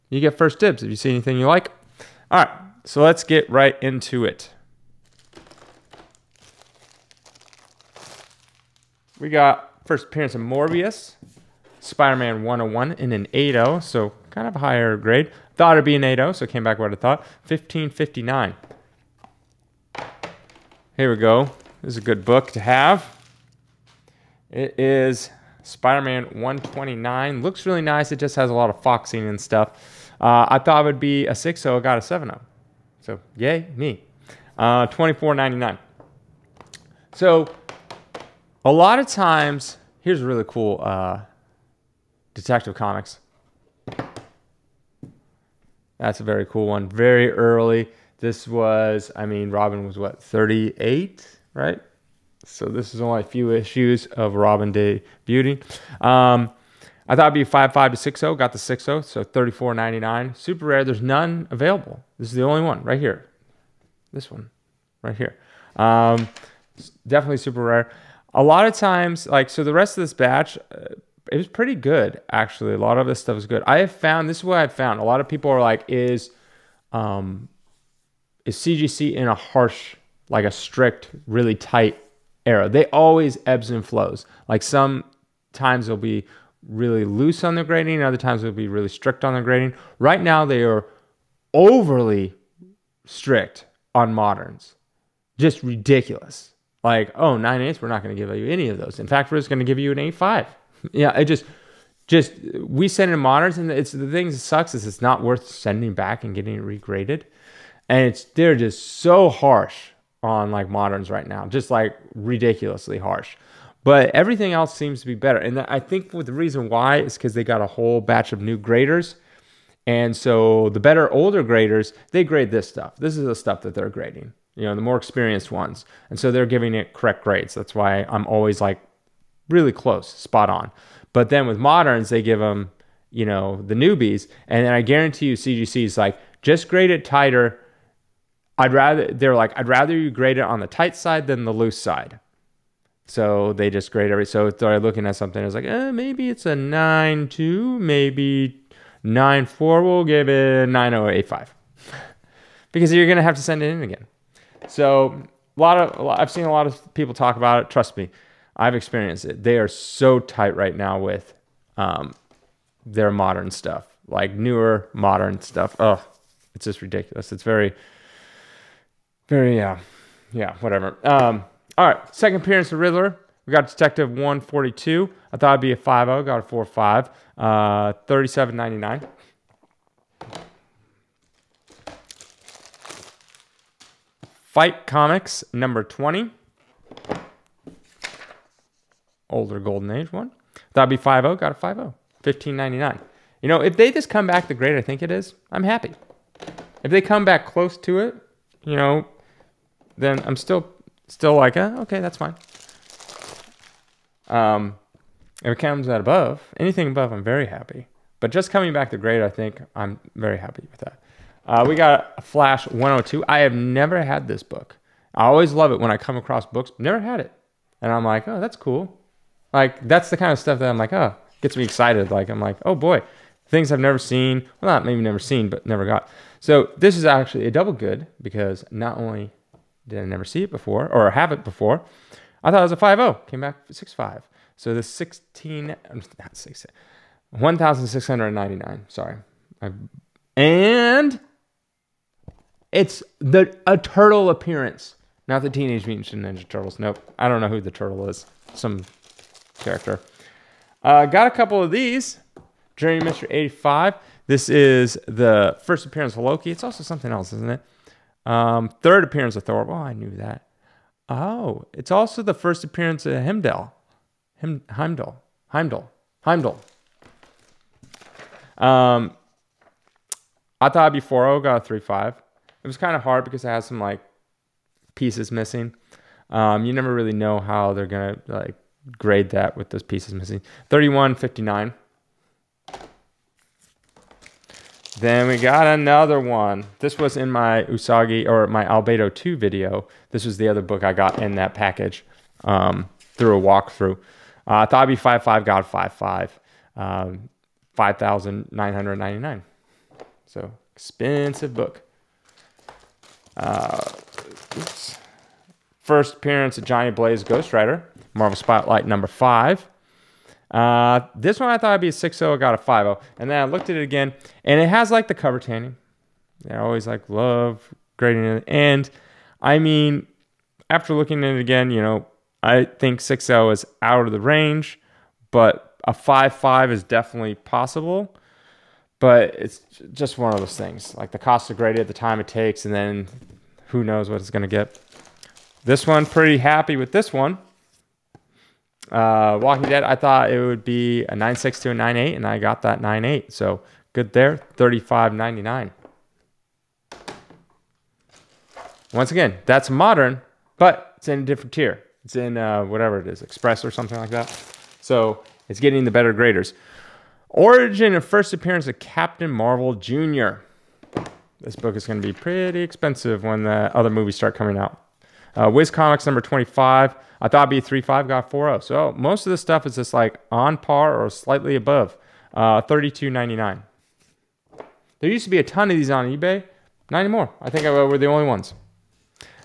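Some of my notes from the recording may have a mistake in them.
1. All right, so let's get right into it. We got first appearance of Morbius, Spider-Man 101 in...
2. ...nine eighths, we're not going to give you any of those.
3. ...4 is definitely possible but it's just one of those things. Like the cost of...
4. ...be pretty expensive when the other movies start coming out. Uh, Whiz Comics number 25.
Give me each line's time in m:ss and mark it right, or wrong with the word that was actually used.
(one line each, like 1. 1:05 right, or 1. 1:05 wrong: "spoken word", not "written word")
1. 0:02 right
2. 1:37 right
3. 5:26 wrong: "5", not "4"
4. 6:02 right.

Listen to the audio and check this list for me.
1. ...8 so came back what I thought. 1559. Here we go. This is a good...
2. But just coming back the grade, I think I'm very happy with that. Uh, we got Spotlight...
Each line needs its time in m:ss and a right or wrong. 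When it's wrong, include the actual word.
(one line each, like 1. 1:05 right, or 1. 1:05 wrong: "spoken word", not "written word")
1. 0:16 right
2. 3:28 wrong: "Flash", not "Spotlight".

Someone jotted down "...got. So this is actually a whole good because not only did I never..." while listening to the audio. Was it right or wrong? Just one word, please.
wrong.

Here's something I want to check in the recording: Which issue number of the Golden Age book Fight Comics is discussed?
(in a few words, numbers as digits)
20.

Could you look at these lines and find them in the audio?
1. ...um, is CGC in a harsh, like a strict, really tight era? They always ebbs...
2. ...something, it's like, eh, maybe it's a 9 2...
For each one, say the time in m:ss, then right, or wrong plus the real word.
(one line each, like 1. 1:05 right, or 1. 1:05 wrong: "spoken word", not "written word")
1. 1:16 right
2. 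2:25 right.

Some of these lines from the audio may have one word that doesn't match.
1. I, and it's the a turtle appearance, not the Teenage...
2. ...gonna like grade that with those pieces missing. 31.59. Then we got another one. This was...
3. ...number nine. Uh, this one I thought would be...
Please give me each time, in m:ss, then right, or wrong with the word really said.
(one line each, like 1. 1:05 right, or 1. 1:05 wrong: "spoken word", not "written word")
1. 3:59 right
2. 4:37 right
3. 5:08 wrong: "five", not "nine".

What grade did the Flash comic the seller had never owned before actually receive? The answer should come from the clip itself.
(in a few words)
6.5.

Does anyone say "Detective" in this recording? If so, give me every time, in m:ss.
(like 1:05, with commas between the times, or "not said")
0:42, 2:53.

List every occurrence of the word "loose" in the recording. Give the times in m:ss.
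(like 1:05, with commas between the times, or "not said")
1:27, 2:21.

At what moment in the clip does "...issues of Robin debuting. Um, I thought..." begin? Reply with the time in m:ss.
0:53.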